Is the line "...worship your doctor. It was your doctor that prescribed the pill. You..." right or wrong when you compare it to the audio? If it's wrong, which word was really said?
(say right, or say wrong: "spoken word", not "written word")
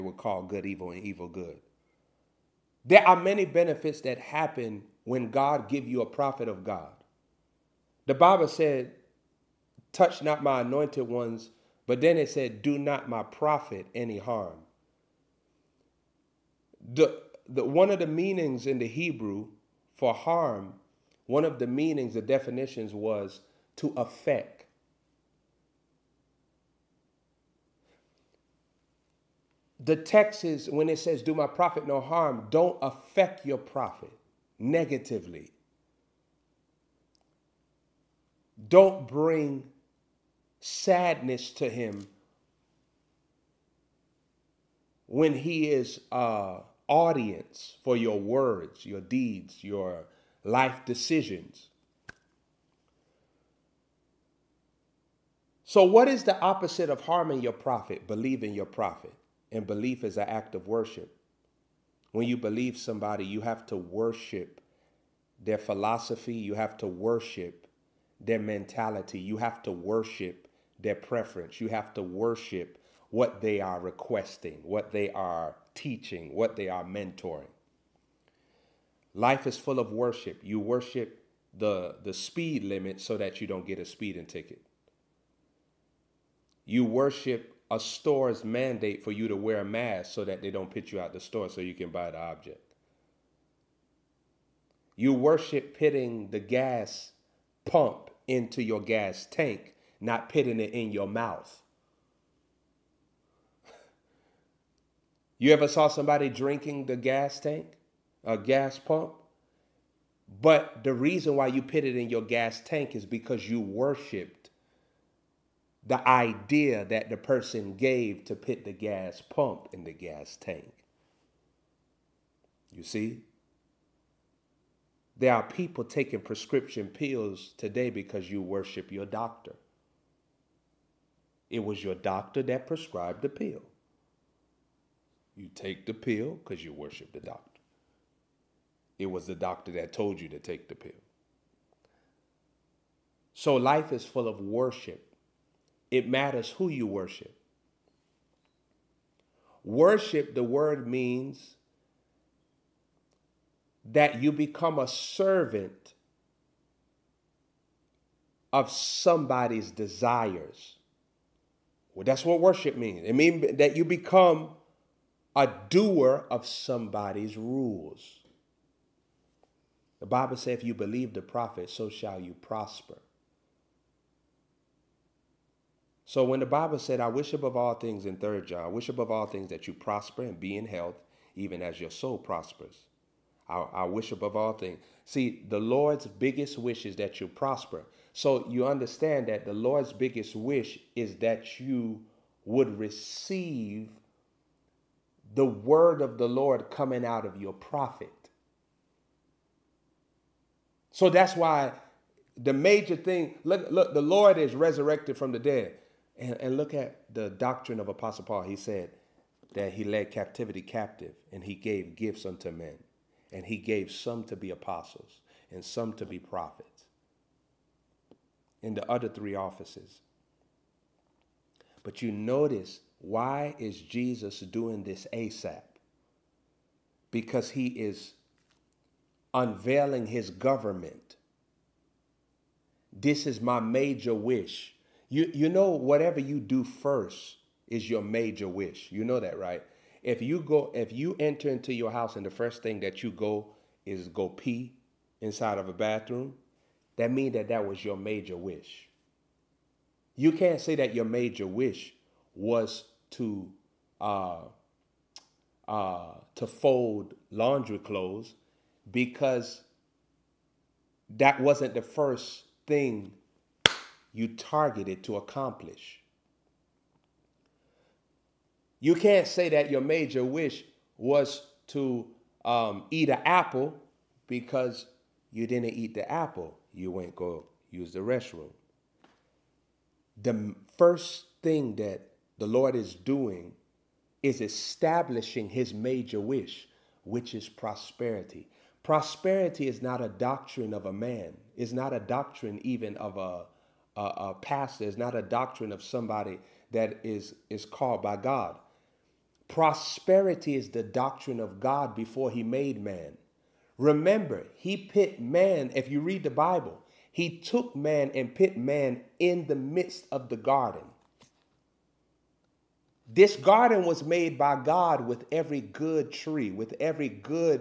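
right.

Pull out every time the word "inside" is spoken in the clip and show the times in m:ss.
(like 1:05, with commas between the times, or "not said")
4:05.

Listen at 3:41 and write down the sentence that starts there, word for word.
But you notice why is Jesus doing this ASAP?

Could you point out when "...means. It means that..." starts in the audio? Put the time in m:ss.
2:42.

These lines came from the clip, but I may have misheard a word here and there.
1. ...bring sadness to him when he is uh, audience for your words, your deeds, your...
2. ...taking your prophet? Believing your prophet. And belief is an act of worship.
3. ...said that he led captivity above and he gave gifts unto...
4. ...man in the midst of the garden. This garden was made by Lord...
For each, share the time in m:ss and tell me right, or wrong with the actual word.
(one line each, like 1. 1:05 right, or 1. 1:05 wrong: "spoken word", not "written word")
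1. 0:39 right
2. 0:57 wrong: "harming", not "taking"
3. 3:28 wrong: "captive", not "above"
4. 5:08 wrong: "God", not "Lord".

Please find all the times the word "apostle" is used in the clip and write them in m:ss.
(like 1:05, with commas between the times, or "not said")
3:27, 3:34.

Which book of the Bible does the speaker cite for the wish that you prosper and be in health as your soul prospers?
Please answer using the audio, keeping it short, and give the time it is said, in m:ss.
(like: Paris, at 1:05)
Third John, at 2:58.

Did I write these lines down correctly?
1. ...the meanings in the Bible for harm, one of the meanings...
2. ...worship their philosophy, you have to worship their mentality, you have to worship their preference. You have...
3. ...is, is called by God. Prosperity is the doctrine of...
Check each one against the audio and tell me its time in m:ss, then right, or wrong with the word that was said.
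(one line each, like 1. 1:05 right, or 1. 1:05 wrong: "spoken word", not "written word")
1. 0:17 wrong: "Hebrew", not "Bible"
2. 1:03 right
3. 4:57 right.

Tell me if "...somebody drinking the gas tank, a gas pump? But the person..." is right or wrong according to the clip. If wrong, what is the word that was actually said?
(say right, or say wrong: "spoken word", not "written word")
wrong: "reason", not "person".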